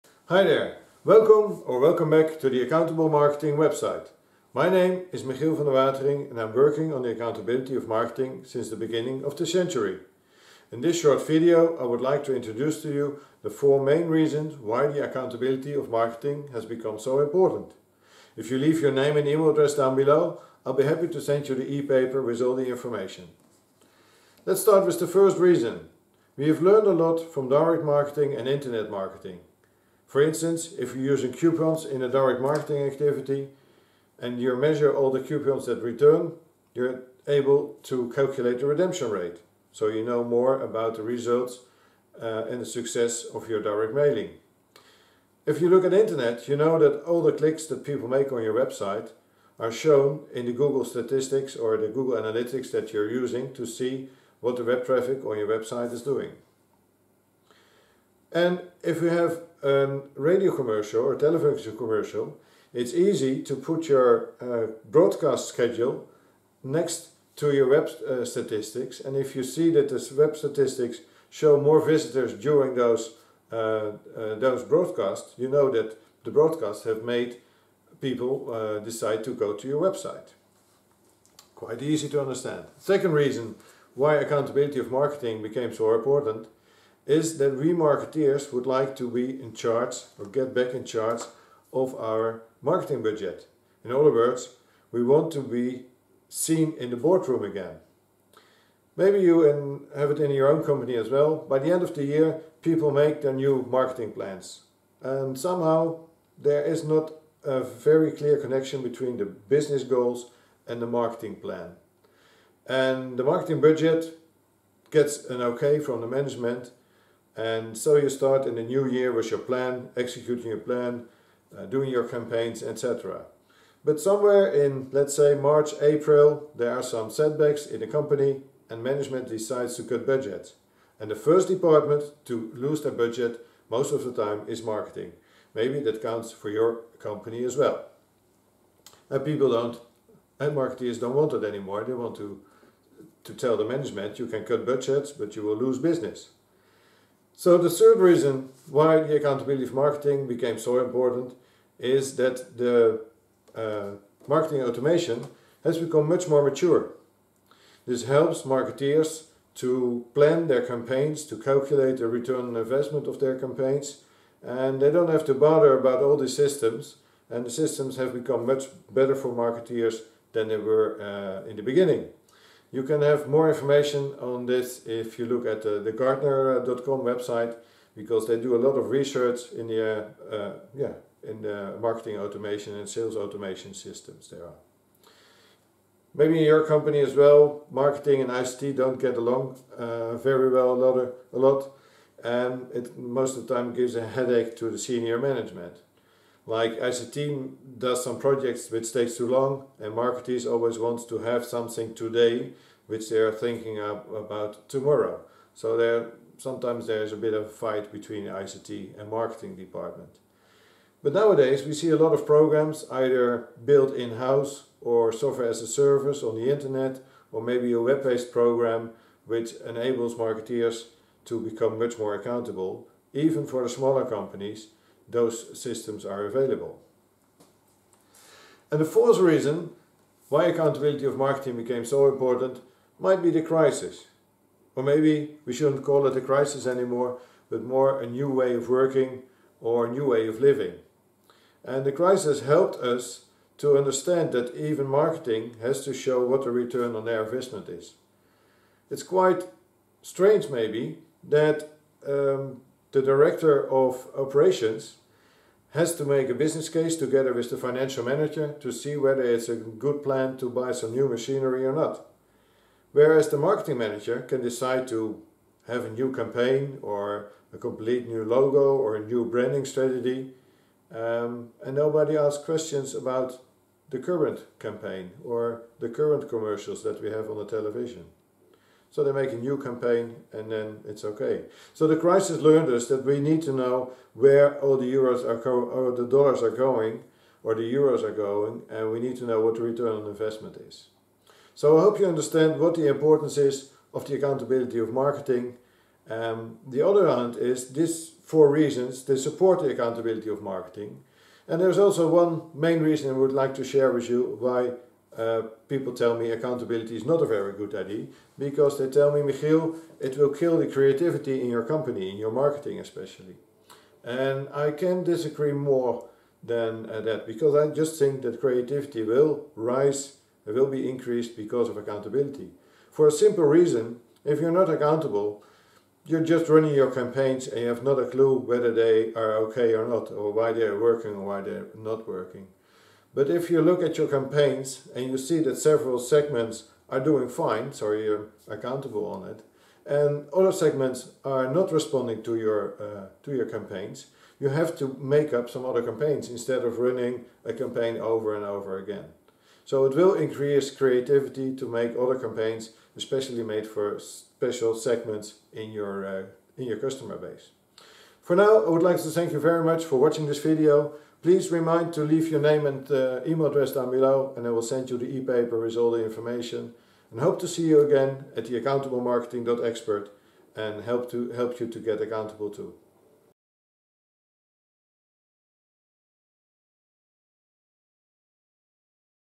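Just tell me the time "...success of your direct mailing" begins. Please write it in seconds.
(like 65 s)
42 s.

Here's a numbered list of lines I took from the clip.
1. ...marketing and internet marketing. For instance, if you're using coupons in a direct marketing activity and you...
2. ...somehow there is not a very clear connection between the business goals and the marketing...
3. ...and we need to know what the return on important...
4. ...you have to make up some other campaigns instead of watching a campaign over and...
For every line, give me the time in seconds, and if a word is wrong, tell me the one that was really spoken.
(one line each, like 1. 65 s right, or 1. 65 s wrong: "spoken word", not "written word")
1. 27 s right
2. 105 s right
3. 288 s wrong: "investment", not "important"
4. 344 s wrong: "running", not "watching".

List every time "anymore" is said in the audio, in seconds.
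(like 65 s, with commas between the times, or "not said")
141 s, 236 s.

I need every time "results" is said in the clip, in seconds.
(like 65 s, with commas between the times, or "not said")
41 s.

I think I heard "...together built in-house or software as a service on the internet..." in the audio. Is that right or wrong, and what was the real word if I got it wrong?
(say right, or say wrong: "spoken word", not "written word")
wrong: "either", not "together".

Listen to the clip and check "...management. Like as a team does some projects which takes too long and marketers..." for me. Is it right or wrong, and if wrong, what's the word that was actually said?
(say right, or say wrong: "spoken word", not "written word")
right.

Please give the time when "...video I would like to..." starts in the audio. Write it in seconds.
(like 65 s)
11 s.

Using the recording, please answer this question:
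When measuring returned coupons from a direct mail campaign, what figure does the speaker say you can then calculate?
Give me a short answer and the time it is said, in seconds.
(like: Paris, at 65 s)
redemption rate, at 38 s.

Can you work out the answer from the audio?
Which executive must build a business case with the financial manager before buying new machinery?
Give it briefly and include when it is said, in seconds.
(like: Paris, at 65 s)
director of operations, at 253 s.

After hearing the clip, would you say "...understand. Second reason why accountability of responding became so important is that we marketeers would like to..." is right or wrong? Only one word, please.
wrong.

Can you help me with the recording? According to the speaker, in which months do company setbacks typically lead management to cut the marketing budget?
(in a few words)
March, April.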